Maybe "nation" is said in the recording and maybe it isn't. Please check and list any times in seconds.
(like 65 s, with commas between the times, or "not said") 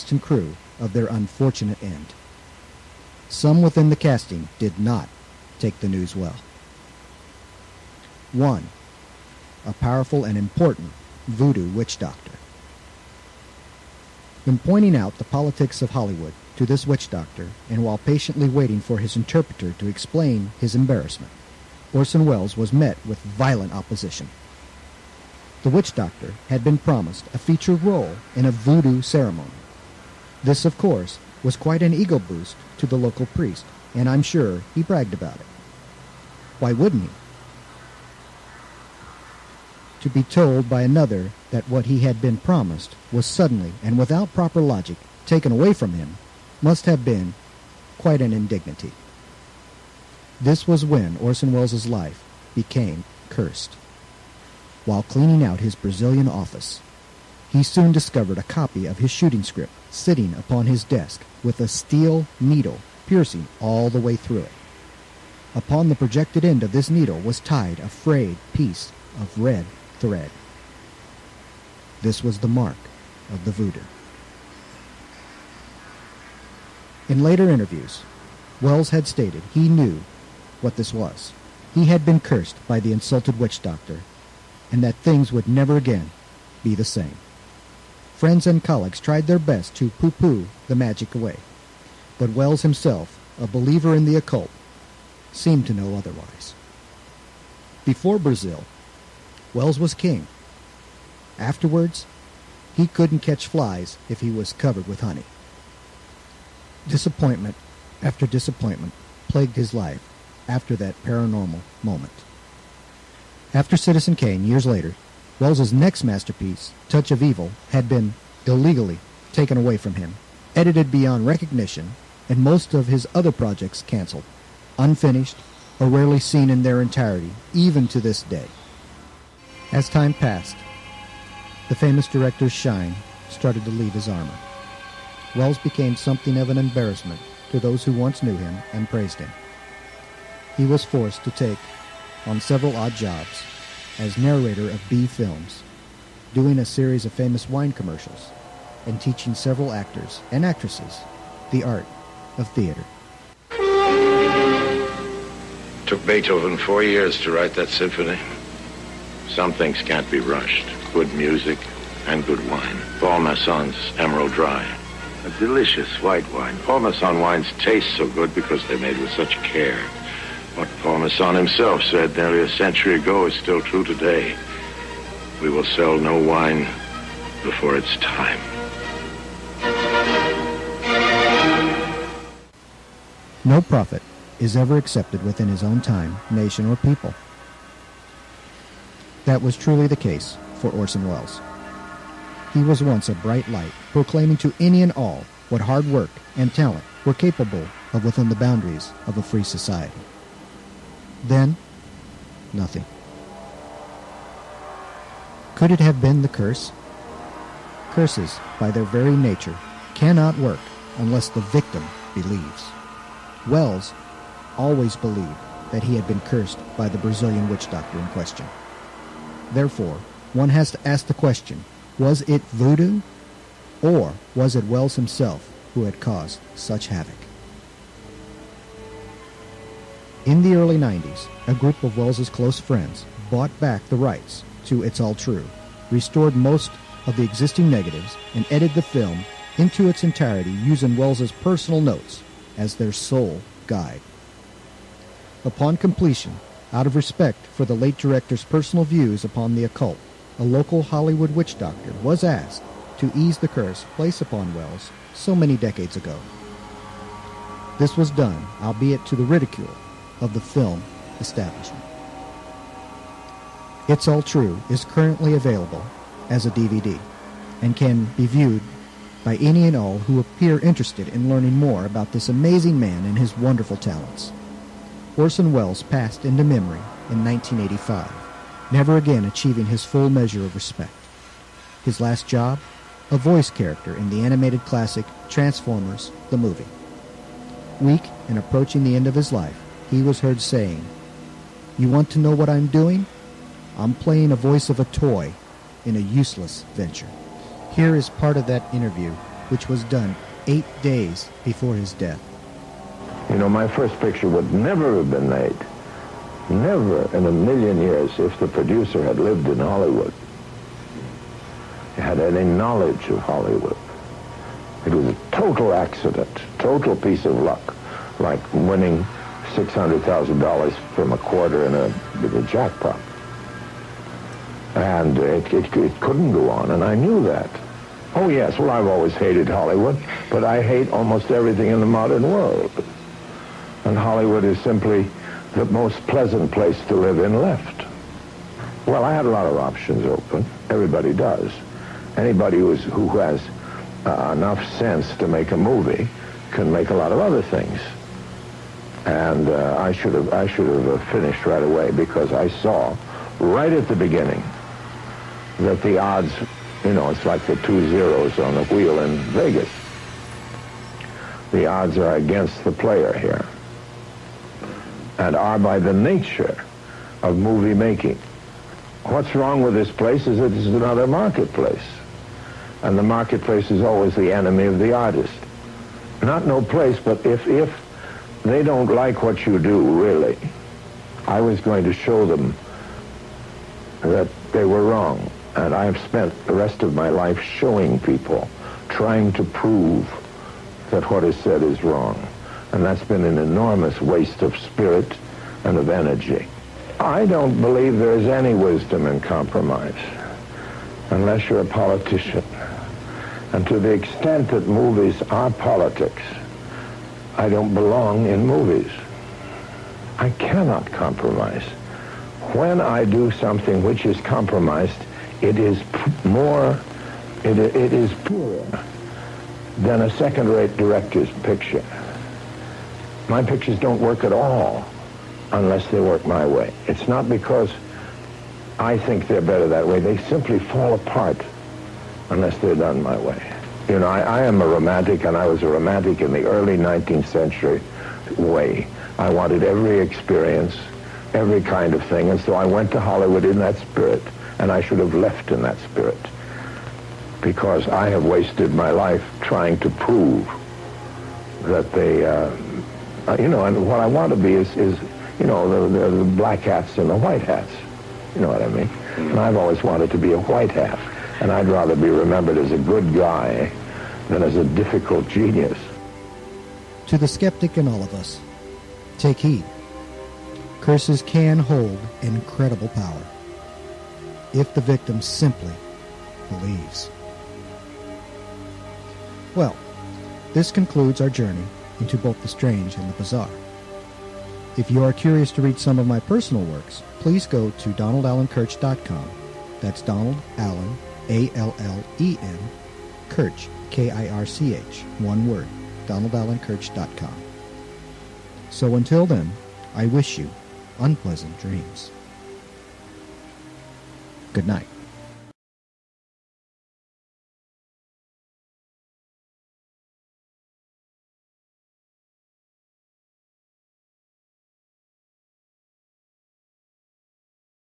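186 s.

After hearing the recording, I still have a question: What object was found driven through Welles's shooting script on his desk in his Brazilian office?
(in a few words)
A steel needle.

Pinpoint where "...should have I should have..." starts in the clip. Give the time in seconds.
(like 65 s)
349 s.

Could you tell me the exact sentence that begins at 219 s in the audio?
Therefore, one has to ask the question was it voodoo, or was it Welles himself who had caused such havoc?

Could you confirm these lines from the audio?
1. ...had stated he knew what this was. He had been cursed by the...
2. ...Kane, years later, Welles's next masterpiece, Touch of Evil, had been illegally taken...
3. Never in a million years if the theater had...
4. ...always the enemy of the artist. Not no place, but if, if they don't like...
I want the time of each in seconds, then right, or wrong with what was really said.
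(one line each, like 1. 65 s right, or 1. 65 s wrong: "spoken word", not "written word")
1. 78 s right
2. 114 s right
3. 306 s wrong: "producer", not "theater"
4. 373 s right.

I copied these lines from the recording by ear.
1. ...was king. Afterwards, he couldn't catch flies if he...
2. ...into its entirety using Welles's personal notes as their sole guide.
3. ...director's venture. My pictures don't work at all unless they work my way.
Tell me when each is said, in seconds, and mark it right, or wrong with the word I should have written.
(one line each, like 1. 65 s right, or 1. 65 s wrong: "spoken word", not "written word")
1. 99 s right
2. 239 s right
3. 420 s wrong: "picture", not "venture".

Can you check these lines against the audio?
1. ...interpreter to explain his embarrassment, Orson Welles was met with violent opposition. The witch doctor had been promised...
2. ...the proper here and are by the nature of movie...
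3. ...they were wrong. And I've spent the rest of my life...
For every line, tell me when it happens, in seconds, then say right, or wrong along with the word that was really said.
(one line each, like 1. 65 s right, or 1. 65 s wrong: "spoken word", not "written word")
1. 19 s right
2. 362 s wrong: "player", not "proper"
3. 384 s right.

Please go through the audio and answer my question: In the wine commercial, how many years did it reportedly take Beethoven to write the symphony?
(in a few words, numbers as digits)
4.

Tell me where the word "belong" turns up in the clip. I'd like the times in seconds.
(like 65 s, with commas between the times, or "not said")
407 s.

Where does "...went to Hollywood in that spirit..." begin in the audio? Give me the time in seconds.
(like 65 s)
442 s.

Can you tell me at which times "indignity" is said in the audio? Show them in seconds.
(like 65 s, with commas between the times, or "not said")
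48 s.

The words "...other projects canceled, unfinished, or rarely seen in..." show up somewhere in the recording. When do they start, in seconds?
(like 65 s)
123 s.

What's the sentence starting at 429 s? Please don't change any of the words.
They simply fall apart unless they're done my way.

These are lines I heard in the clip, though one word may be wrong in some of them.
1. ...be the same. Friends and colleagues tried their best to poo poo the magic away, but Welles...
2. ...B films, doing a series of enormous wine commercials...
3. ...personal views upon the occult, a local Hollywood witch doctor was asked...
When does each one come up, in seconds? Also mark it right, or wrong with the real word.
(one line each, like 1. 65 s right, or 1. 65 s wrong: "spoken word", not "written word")
1. 86 s right
2. 144 s wrong: "famous", not "enormous"
3. 248 s right.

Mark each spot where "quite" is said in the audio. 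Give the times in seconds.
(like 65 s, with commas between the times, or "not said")
31 s, 47 s.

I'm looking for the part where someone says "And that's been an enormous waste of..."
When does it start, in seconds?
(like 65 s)
392 s.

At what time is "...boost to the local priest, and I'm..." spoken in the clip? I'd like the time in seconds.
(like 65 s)
32 s.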